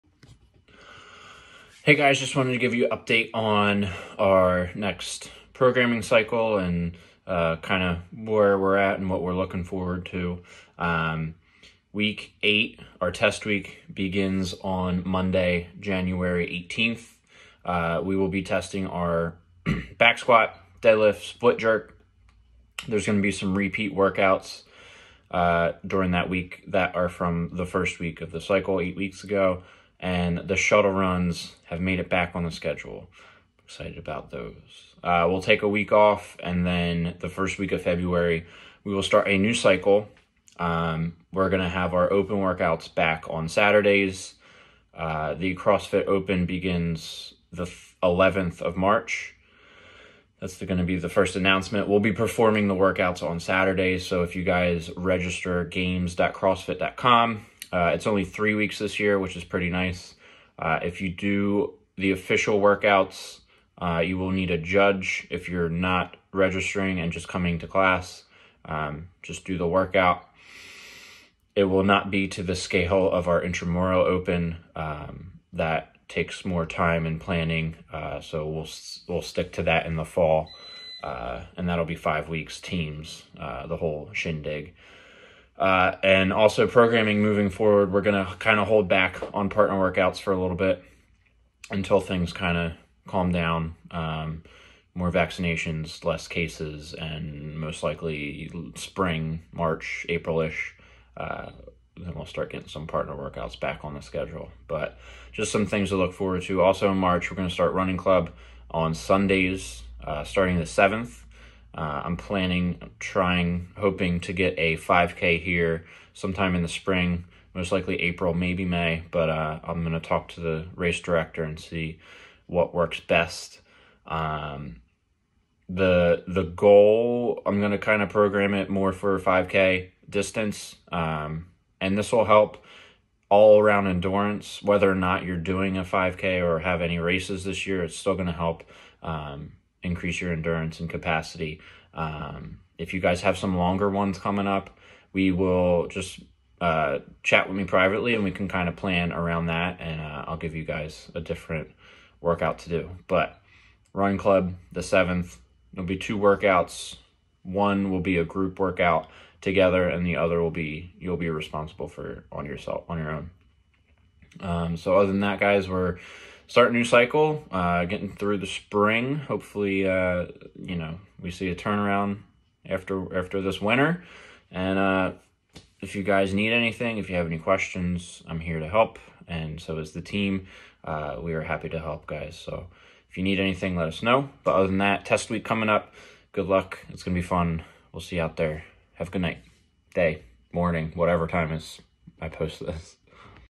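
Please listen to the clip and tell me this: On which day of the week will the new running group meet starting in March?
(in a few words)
Sundays.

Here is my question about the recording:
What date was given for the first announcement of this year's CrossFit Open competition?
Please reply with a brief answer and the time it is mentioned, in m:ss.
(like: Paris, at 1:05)
March 11, at 0:47.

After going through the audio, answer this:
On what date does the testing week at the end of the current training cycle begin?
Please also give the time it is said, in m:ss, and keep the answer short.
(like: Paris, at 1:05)
January 18, at 0:15.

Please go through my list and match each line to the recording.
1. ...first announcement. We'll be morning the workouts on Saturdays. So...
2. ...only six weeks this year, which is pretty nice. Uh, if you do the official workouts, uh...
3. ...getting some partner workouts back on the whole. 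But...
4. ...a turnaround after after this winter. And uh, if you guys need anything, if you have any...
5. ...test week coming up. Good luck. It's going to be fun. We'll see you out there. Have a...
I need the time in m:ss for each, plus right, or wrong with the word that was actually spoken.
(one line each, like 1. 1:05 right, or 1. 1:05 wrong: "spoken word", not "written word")
1. 0:51 wrong: "performing", not "morning"
2. 0:58 wrong: "three", not "six"
3. 1:42 wrong: "schedule", not "whole"
4. 2:51 right
5. 3:05 right.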